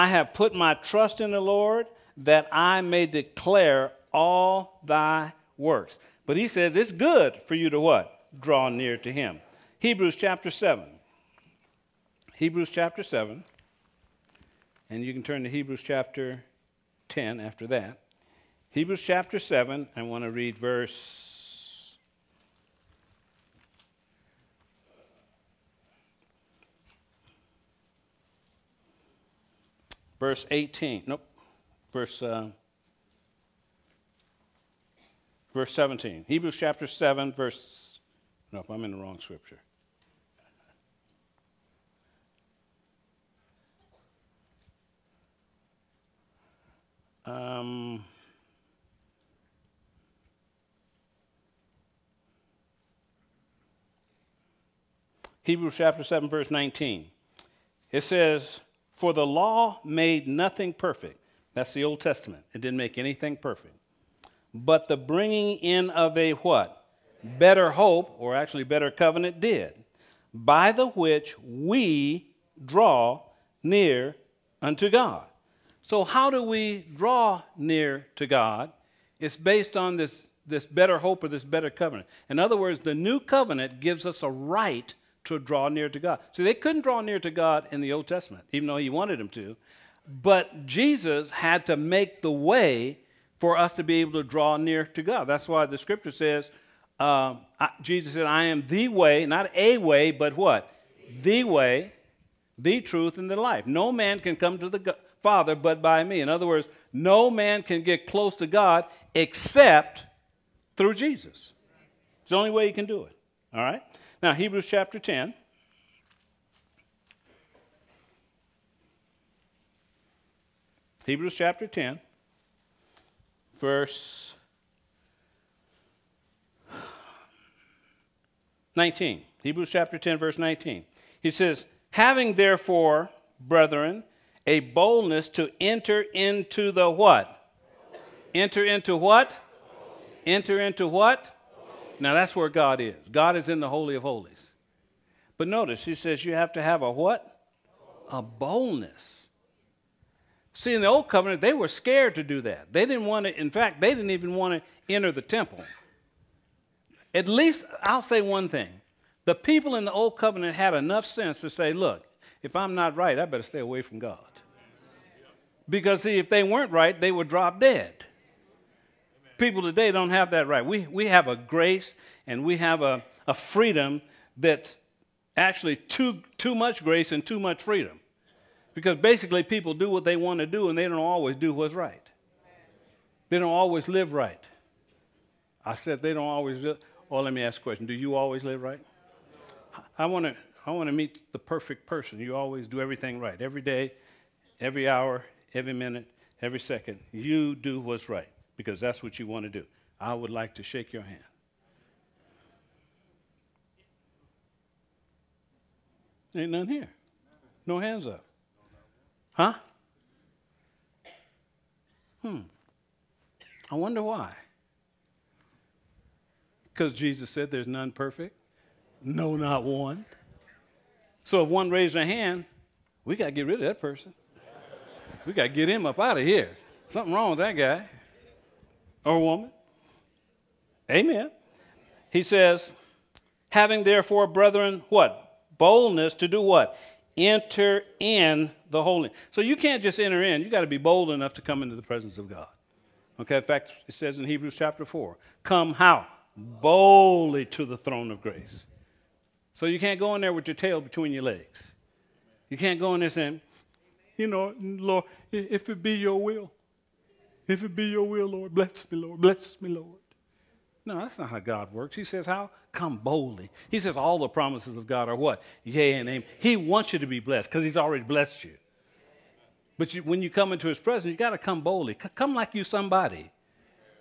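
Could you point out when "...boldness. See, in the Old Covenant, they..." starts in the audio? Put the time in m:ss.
2:28.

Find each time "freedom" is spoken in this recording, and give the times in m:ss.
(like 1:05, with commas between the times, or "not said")
2:53, 2:57.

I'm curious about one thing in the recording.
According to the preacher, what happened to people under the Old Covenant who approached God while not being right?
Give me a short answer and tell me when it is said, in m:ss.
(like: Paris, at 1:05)
They would drop dead, at 2:46.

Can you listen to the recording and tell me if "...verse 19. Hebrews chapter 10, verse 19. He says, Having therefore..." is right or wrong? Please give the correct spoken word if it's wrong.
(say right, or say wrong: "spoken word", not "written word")
right.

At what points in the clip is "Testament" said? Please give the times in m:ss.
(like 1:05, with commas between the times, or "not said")
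1:02, 1:28.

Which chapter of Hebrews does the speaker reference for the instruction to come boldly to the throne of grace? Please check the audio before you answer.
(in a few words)
Chapter 4.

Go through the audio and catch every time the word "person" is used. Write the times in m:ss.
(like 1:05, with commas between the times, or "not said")
3:11, 3:43.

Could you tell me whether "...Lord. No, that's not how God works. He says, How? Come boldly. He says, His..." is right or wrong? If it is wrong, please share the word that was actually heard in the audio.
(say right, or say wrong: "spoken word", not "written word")
wrong: "All", not "His".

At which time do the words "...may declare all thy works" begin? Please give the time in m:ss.
0:02.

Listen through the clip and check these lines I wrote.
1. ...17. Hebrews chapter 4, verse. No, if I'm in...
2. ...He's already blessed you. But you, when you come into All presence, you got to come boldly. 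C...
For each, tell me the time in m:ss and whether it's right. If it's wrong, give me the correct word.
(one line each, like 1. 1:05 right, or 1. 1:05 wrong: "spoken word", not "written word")
1. 0:35 wrong: "7", not "4"
2. 4:27 wrong: "His", not "All".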